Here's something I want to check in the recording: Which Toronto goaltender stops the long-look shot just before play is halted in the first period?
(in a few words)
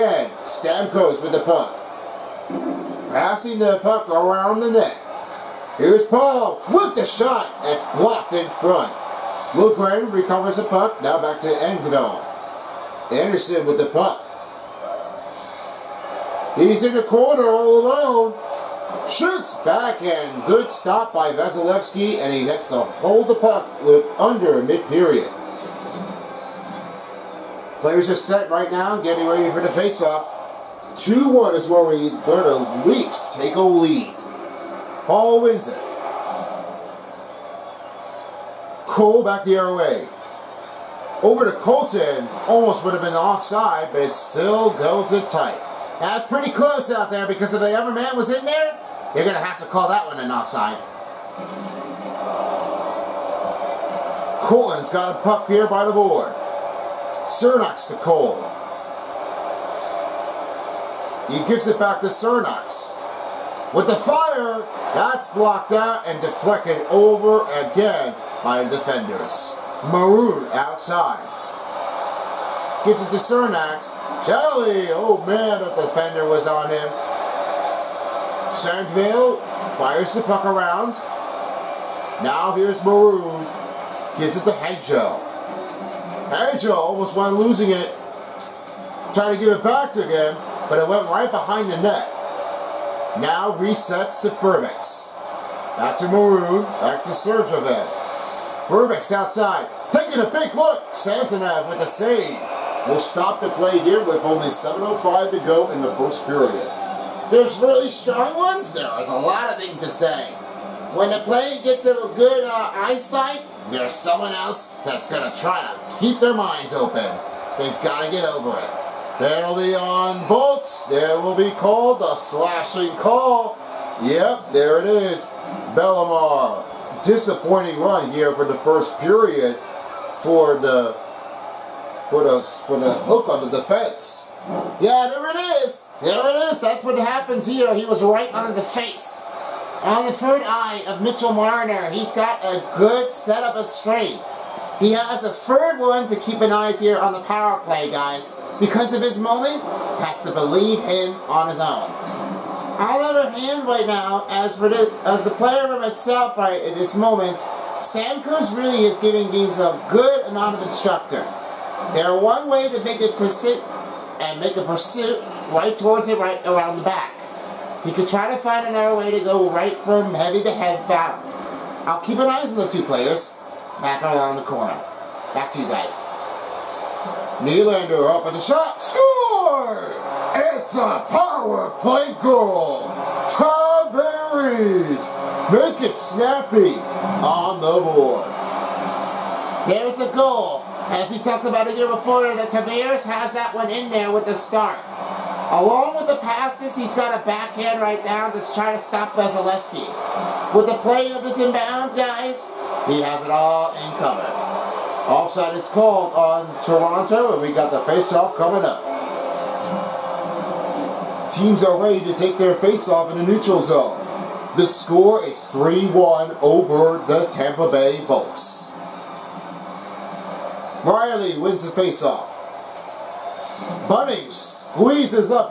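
Samsonov.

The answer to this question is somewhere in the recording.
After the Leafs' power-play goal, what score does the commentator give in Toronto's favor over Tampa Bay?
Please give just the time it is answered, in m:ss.
3:35.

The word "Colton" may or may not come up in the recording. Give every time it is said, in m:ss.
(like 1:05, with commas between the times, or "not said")
0:41.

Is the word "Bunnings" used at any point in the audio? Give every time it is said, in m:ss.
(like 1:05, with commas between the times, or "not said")
3:43.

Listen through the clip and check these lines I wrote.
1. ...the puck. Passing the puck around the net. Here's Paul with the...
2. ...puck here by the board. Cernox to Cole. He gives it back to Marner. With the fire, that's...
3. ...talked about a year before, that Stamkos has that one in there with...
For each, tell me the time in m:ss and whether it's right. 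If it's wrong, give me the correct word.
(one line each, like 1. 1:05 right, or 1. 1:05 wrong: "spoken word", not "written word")
1. 0:01 right
2. 0:55 wrong: "Cernox", not "Marner"
3. 3:11 wrong: "Tavares", not "Stamkos".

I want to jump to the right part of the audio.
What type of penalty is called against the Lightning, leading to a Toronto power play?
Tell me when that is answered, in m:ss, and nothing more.
2:02.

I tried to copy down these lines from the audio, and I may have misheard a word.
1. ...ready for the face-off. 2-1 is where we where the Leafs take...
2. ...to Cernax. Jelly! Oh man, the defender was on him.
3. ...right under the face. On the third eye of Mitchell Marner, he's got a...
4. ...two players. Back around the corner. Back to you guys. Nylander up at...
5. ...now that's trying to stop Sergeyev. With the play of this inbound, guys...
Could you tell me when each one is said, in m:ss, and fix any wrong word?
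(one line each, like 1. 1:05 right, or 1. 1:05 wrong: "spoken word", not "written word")
1. 0:29 right
2. 1:13 right
3. 2:18 right
4. 2:52 right
5. 3:18 wrong: "Vasilevsky", not "Sergeyev".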